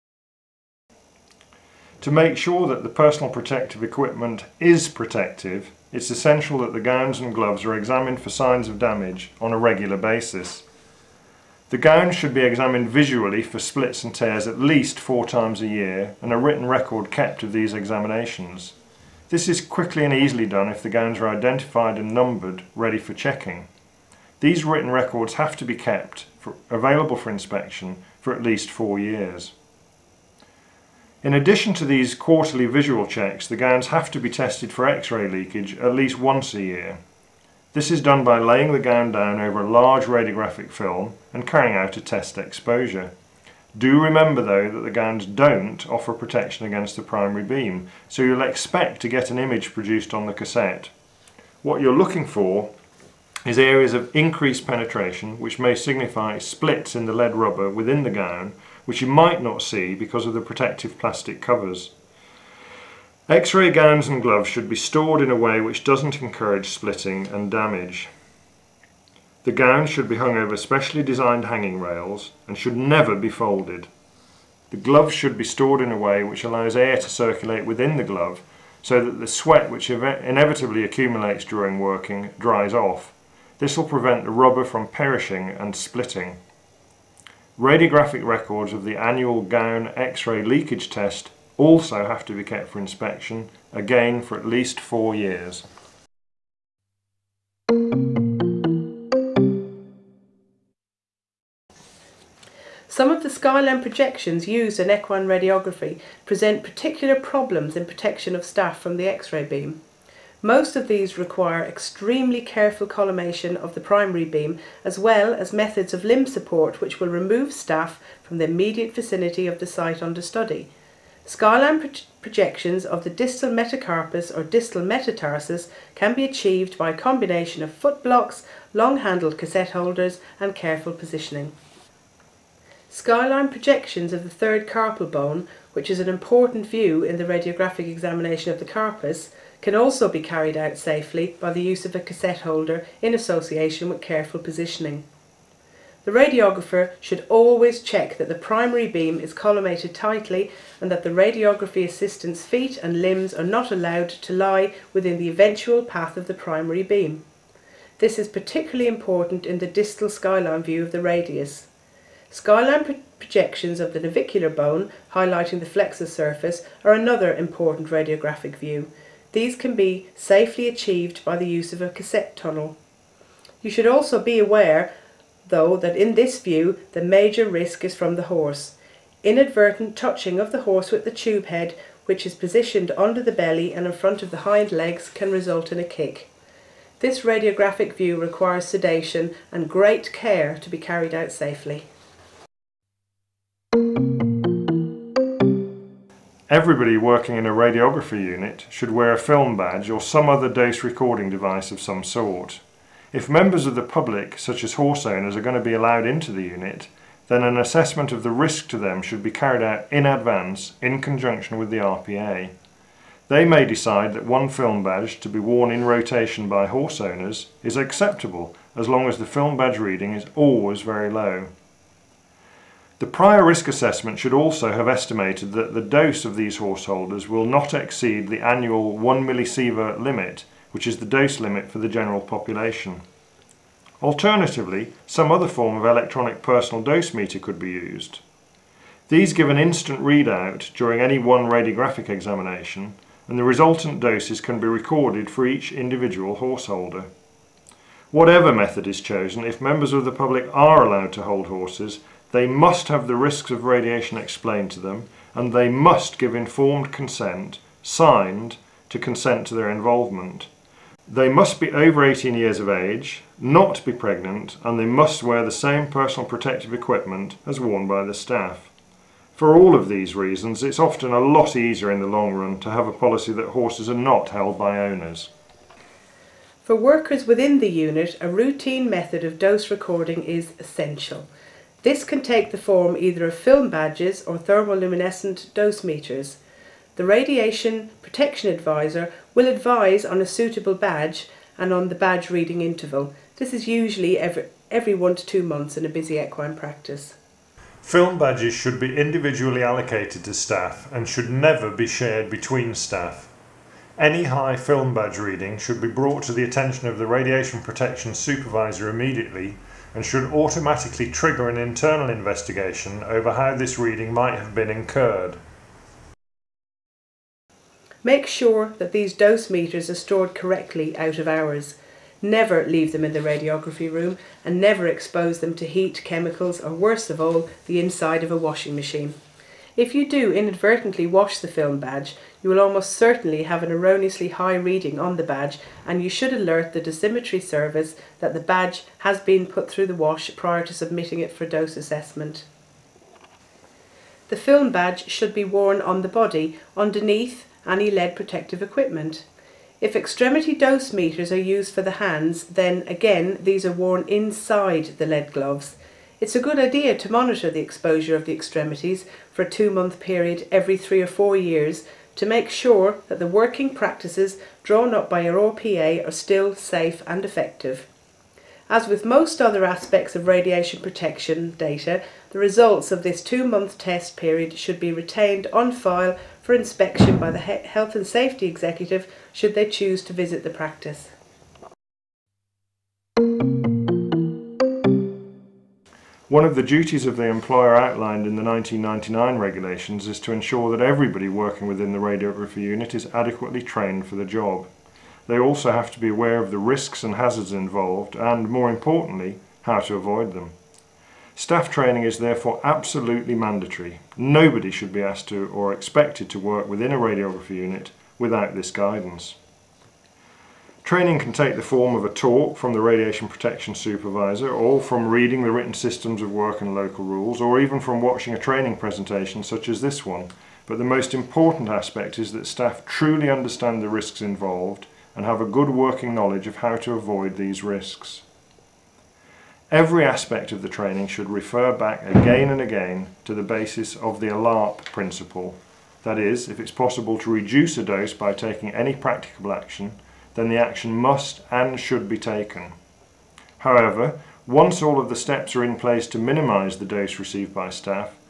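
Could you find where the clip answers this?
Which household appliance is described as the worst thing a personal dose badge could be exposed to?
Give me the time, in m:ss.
5:28.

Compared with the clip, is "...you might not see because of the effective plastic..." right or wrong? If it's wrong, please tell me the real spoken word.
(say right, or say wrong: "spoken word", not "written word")
wrong: "protective", not "effective".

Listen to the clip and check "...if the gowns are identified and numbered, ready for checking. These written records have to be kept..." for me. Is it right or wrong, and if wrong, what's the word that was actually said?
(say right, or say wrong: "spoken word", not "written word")
right.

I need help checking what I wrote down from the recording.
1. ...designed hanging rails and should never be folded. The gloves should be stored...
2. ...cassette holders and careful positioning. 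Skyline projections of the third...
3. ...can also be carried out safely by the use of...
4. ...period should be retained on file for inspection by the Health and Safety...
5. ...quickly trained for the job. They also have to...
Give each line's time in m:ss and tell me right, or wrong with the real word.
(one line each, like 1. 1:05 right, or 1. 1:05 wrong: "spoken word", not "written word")
1. 1:11 right
2. 2:09 right
3. 2:19 right
4. 6:14 right
5. 6:33 wrong: "adequately", not "quickly".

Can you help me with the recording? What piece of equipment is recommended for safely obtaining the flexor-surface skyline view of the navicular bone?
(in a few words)
cassette tunnel.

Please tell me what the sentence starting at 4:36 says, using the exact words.
For workers within the unit, a routine method of dose recording is essential.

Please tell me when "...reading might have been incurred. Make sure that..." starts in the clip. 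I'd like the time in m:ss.
5:13.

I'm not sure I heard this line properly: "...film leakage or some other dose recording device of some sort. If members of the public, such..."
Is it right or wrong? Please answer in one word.
wrong.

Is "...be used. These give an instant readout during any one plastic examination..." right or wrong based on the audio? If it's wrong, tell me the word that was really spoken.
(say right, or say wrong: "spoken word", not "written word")
wrong: "radiographic", not "plastic".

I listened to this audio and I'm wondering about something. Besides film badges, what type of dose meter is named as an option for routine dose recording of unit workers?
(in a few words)
thermoluminescent dose meters.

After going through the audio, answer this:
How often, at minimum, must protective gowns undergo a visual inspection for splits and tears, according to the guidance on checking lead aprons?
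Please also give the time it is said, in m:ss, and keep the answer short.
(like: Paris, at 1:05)
4 times a year, at 0:14.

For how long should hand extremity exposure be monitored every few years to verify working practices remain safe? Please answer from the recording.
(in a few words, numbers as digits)
2 months.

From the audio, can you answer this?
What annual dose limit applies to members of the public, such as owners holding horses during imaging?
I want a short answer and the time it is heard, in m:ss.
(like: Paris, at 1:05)
1 millisievert, at 3:48.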